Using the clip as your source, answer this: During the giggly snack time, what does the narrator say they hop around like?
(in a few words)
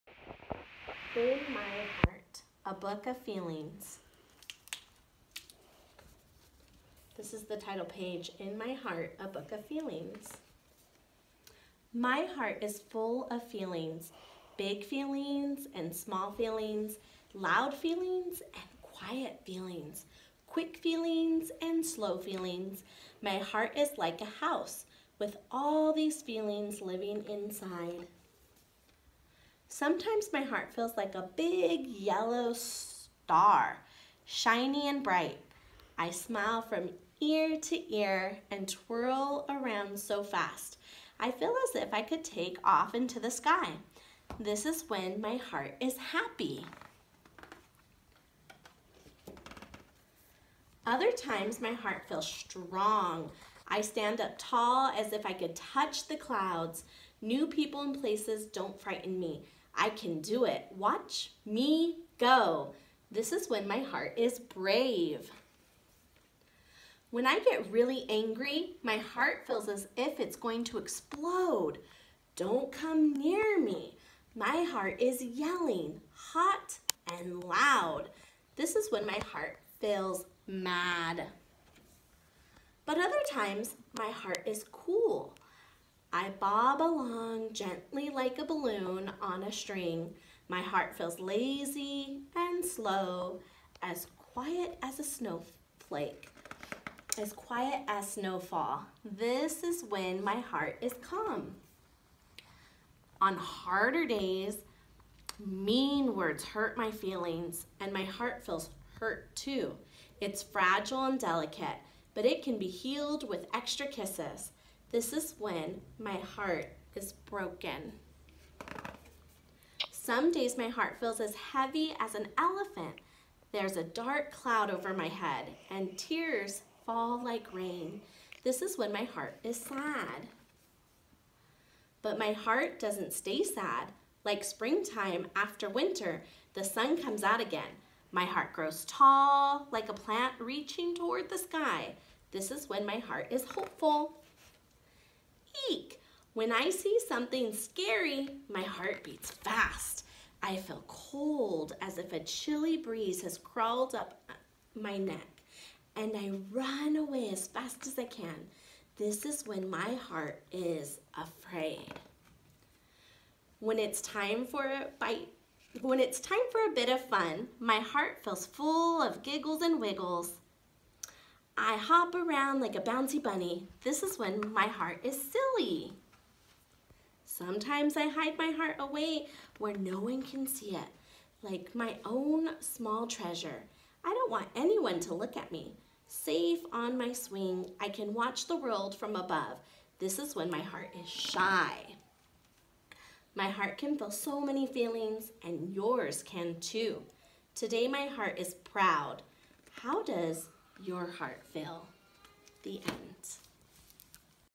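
bouncy bunny.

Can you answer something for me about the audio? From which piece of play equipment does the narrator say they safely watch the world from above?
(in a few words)
swing.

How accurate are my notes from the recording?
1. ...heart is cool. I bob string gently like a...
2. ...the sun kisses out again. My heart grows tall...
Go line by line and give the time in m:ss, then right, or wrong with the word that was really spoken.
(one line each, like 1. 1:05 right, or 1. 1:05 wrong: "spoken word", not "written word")
1. 1:24 wrong: "along", not "string"
2. 2:16 wrong: "comes", not "kisses".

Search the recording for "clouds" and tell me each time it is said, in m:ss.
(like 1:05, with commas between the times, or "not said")
0:56, 2:04.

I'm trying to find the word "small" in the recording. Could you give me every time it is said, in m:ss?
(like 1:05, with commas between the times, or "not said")
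0:15, 3:02.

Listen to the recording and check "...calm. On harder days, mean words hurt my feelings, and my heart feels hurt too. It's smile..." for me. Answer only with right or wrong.
wrong.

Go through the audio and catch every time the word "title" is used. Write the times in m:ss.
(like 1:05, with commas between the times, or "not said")
0:07.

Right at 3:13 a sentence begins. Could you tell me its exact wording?
My heart can feel so many feelings, and yours can too.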